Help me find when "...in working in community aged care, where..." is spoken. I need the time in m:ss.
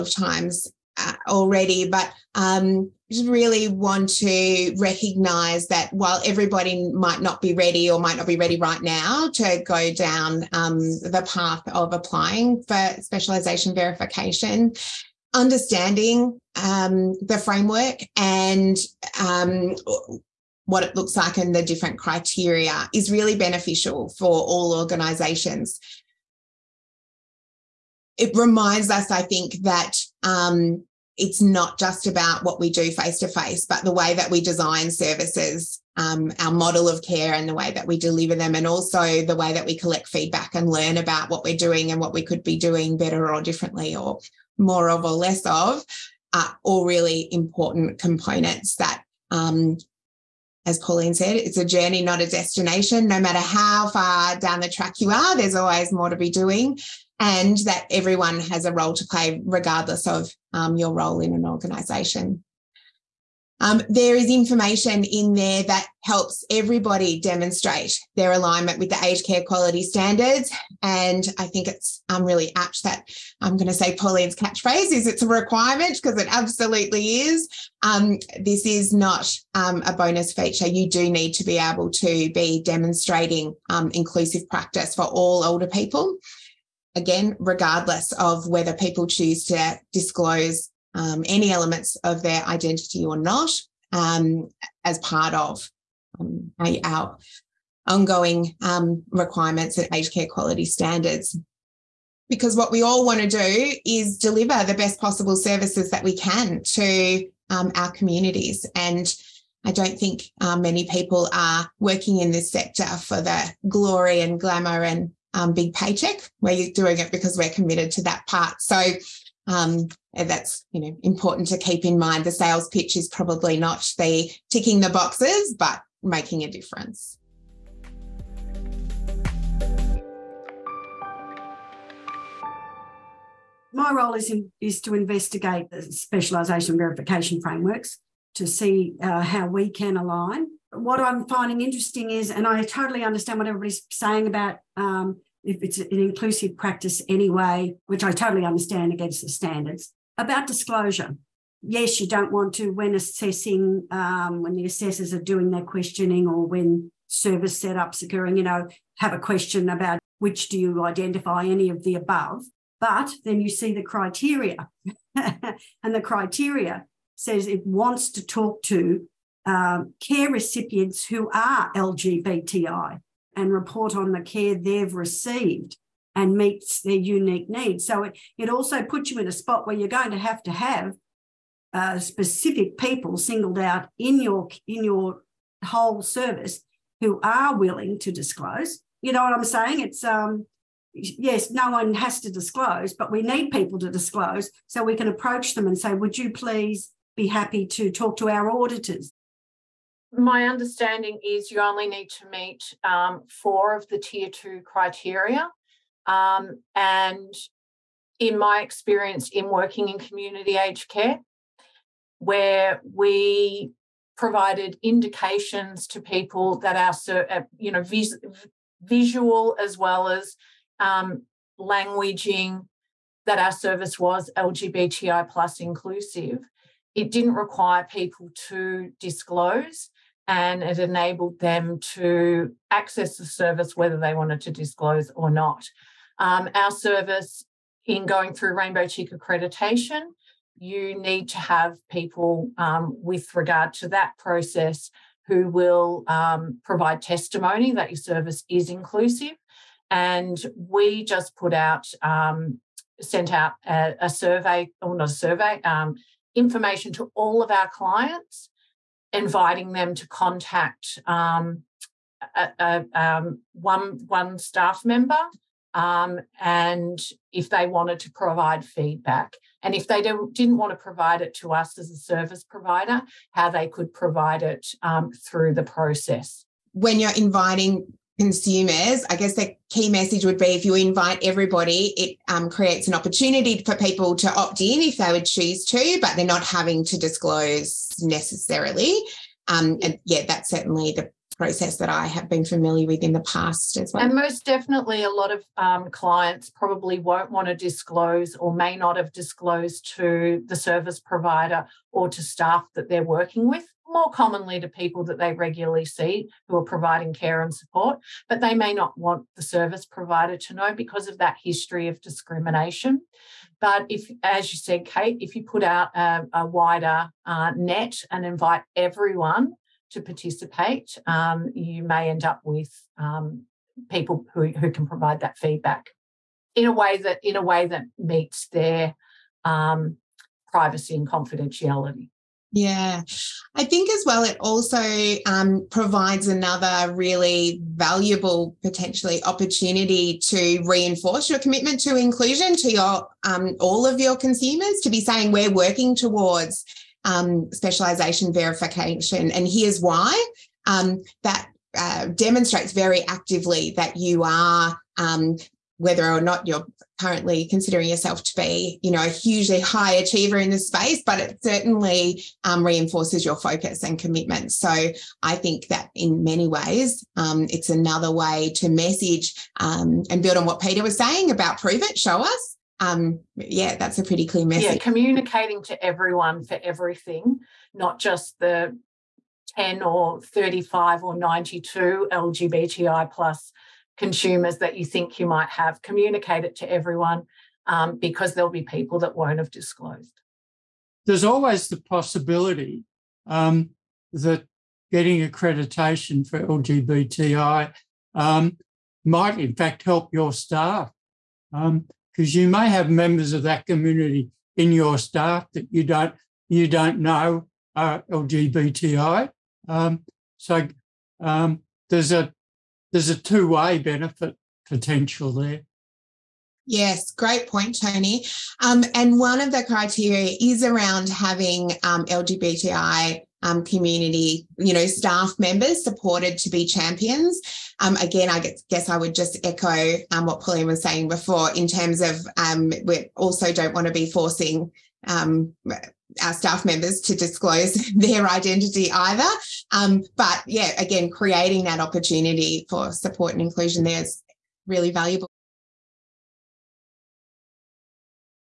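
3:29.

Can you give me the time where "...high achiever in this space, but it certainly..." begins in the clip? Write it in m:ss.
5:59.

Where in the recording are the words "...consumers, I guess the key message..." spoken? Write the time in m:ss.
4:38.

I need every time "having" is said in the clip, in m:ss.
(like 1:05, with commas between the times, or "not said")
4:46, 7:01.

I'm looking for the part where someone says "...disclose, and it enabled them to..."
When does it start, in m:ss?
3:48.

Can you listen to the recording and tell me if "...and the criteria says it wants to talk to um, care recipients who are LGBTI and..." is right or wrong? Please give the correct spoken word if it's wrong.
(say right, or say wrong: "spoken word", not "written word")
right.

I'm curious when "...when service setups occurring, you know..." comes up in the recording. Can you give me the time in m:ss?
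2:36.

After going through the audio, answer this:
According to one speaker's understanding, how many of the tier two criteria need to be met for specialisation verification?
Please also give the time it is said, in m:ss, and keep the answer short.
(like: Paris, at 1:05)
4, at 3:23.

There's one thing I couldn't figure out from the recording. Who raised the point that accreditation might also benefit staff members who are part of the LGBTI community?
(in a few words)
Toni.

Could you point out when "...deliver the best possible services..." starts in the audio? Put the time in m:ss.
1:44.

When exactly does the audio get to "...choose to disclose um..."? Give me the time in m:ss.
1:29.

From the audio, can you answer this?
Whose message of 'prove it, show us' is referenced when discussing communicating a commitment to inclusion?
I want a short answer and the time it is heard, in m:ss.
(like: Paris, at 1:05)
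Peter, at 6:10.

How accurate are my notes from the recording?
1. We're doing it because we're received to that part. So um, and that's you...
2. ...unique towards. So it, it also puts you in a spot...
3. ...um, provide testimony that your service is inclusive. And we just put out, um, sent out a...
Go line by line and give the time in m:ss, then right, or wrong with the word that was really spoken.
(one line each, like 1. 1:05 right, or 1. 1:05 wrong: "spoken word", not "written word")
1. 1:56 wrong: "committed", not "received"
2. 2:56 wrong: "needs", not "towards"
3. 4:06 right.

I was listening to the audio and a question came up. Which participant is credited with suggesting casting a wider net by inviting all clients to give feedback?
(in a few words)
Kate.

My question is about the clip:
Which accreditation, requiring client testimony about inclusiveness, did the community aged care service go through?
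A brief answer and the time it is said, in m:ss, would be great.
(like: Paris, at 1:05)
Rainbow Check, at 3:58.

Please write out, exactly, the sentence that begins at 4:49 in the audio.
Um, and yeah, that's certainly the process that I have been familiar with in the past as well.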